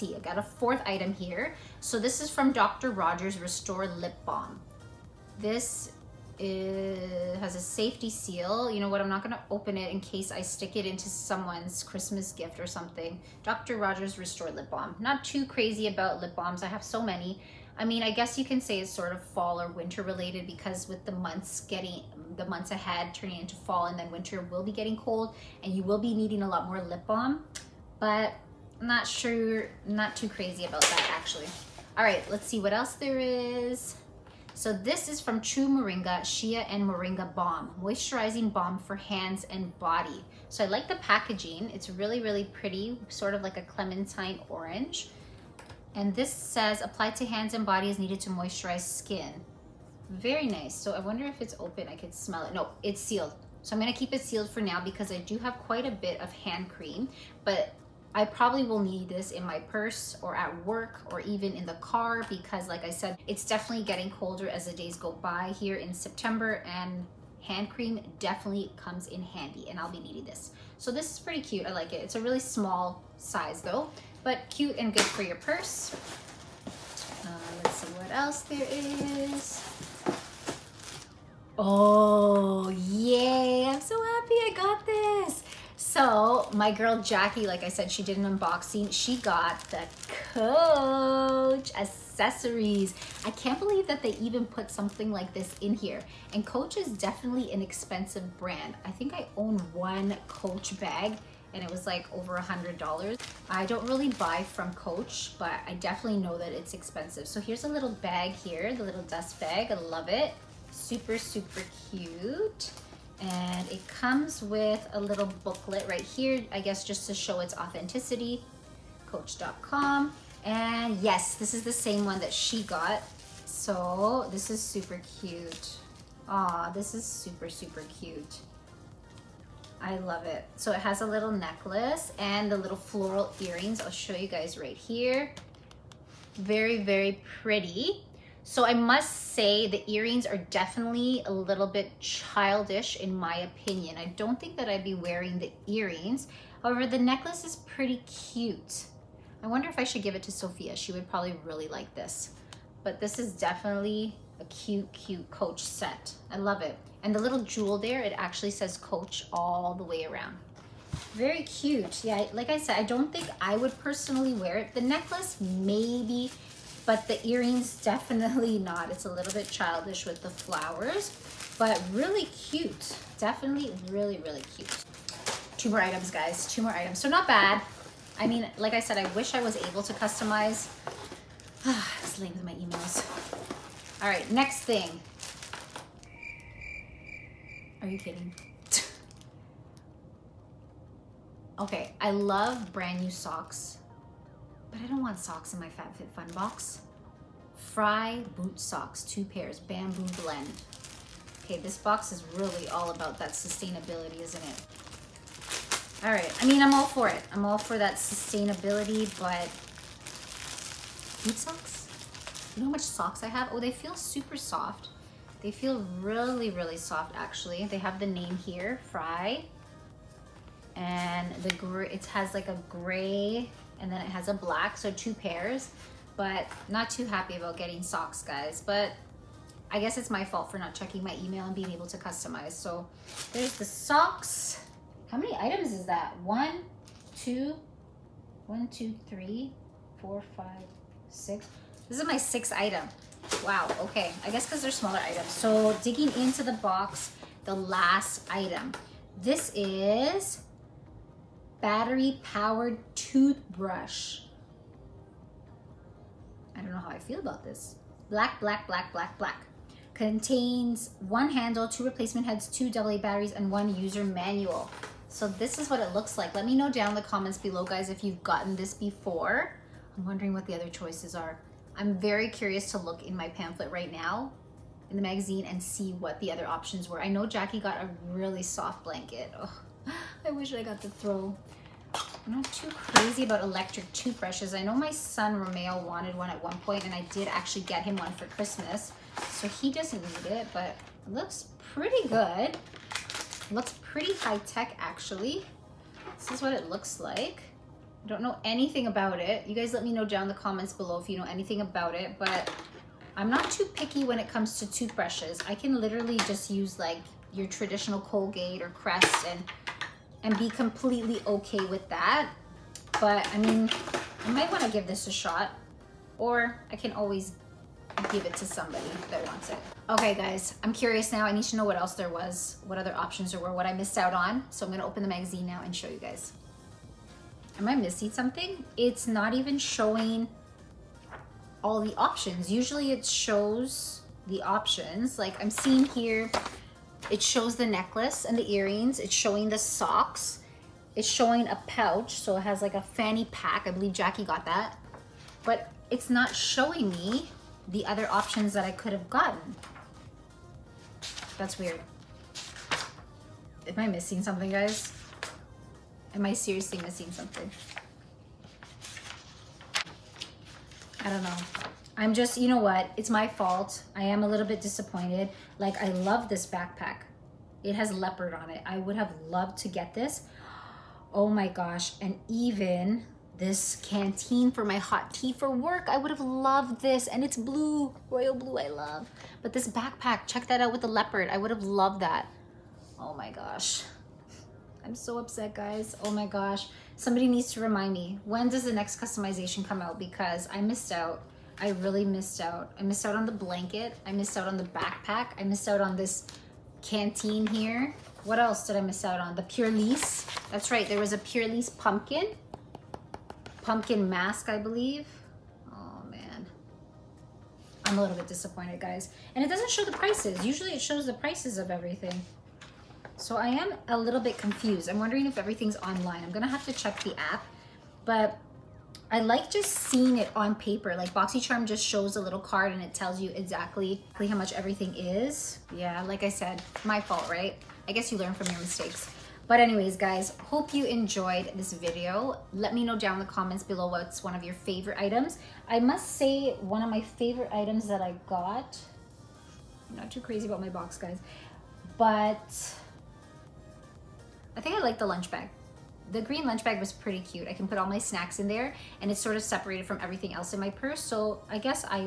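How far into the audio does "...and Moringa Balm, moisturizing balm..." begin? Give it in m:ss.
0:36.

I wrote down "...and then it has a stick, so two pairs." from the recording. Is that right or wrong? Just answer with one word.
wrong.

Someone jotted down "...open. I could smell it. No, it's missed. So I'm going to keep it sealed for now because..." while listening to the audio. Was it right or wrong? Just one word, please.
wrong.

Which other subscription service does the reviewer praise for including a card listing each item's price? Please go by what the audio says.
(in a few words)
BoxyCharm.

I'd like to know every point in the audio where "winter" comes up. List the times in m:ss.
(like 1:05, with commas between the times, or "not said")
0:19, 0:24.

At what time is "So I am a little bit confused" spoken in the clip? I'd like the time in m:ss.
6:53.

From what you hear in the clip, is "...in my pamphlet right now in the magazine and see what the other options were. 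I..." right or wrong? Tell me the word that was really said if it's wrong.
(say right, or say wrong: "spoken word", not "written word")
right.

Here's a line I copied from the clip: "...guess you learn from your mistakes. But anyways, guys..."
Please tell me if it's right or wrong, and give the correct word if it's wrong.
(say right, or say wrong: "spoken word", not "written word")
right.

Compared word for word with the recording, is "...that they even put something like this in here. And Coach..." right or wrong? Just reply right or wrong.
right.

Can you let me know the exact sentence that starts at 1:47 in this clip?
So here's a little bag here, the little dust bag.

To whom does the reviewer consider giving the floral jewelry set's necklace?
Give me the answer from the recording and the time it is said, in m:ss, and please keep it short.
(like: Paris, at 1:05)
Sofia, at 2:30.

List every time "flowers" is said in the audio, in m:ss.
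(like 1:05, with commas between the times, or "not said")
2:50.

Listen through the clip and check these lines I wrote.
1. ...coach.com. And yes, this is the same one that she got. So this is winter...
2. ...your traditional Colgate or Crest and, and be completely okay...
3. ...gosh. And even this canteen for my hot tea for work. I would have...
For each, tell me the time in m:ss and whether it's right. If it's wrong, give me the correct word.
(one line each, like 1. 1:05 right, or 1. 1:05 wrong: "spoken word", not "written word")
1. 1:59 wrong: "super", not "winter"
2. 5:07 right
3. 6:11 right.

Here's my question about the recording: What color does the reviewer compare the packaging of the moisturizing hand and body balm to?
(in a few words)
clementine orange.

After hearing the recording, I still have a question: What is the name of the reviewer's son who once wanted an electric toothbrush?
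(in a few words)
Romeo.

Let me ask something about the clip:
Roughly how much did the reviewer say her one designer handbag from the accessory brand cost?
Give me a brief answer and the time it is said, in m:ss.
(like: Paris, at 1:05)
over $100, at 1:42.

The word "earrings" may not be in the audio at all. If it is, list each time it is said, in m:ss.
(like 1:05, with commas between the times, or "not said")
2:13, 2:19, 2:25, 2:47, 5:38.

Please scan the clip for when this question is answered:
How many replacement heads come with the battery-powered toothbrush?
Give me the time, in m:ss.
4:21.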